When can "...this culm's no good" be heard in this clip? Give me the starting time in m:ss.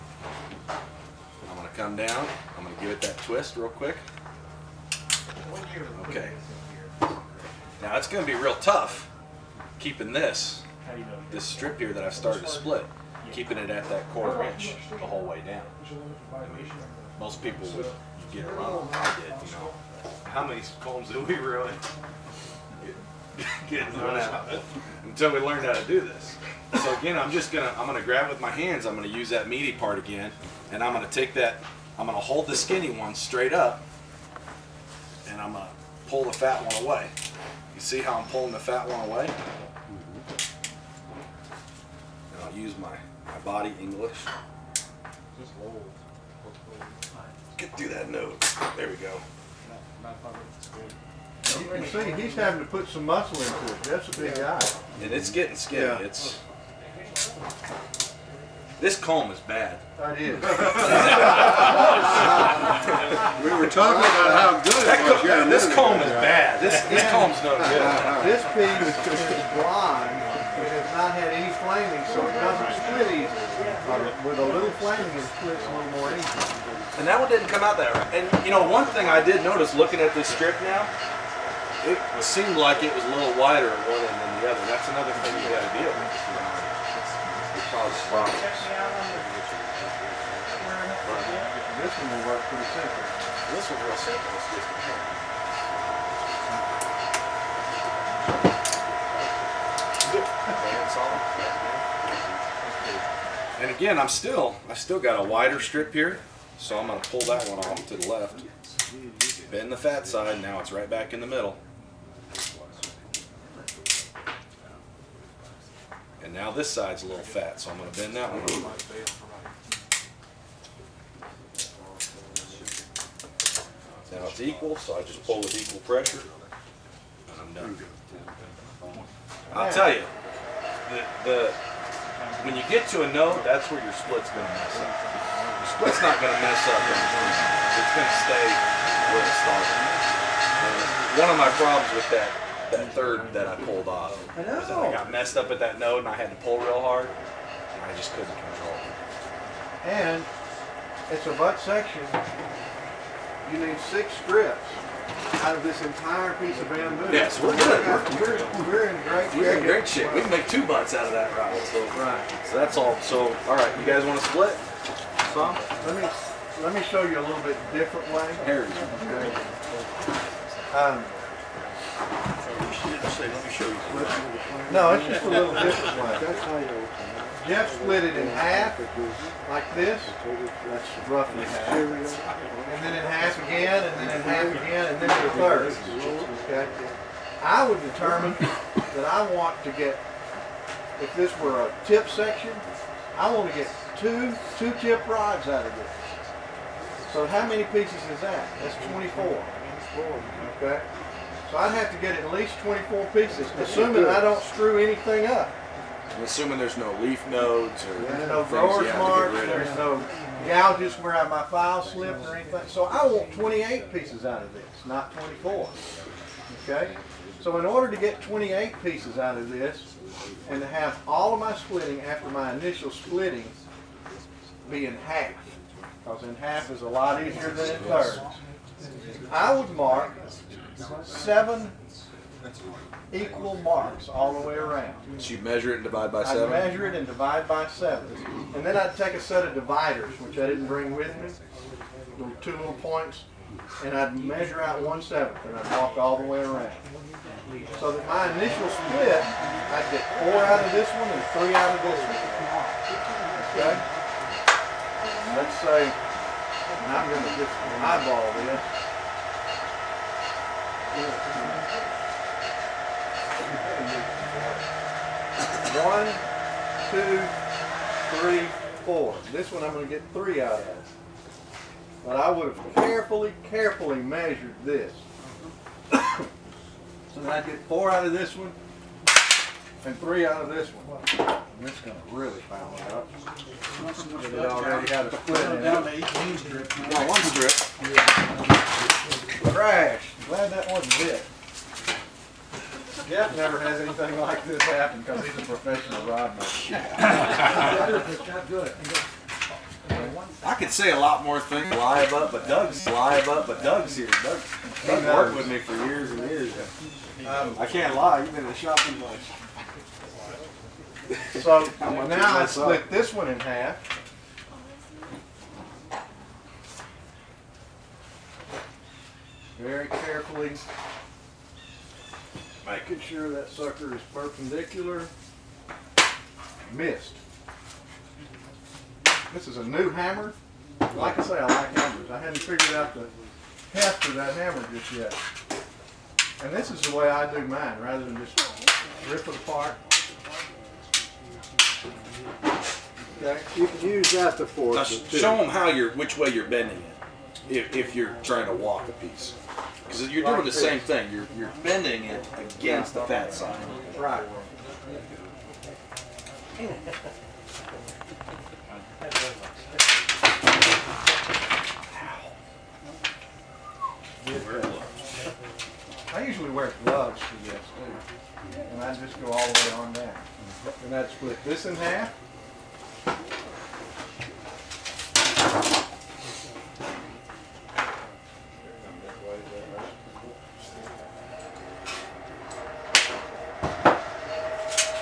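1:06.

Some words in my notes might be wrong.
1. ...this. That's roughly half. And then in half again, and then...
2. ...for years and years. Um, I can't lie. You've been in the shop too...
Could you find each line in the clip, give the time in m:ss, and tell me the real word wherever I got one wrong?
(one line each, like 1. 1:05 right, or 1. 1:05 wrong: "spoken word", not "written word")
1. 2:59 right
2. 5:05 right.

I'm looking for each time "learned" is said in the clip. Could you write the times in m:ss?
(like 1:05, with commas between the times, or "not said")
0:25.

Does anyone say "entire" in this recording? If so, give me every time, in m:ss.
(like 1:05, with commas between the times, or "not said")
2:35.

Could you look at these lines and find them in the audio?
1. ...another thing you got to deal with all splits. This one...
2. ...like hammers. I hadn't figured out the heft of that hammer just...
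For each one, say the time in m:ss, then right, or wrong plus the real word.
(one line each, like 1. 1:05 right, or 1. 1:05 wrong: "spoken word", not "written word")
1. 1:24 wrong: "spots", not "splits"
2. 5:31 right.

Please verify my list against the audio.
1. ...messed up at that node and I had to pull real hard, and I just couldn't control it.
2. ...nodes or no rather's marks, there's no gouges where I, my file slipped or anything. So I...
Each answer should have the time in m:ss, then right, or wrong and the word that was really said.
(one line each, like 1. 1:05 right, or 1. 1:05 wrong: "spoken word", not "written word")
1. 2:25 right
2. 3:27 wrong: "grower", not "rather".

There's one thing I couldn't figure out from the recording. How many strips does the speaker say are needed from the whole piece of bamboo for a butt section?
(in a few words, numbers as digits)
6.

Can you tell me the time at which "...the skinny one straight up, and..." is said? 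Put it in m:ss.
0:32.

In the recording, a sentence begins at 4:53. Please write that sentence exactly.
Jeff never has anything like this happen because he's a professional rodman.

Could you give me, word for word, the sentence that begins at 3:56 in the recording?
I measure it and divide by seven.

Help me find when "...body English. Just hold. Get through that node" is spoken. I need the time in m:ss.
0:43.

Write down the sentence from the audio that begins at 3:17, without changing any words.
So how many pieces is that?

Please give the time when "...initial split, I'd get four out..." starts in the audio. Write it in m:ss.
4:08.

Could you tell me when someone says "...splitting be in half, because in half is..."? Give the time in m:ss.
3:42.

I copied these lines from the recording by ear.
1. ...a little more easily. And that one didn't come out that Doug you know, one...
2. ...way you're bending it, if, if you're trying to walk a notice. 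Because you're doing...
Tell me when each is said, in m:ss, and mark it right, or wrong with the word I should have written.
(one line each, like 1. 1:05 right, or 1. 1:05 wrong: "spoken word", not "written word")
1. 1:15 wrong: "And", not "Doug"
2. 5:46 wrong: "piece", not "notice".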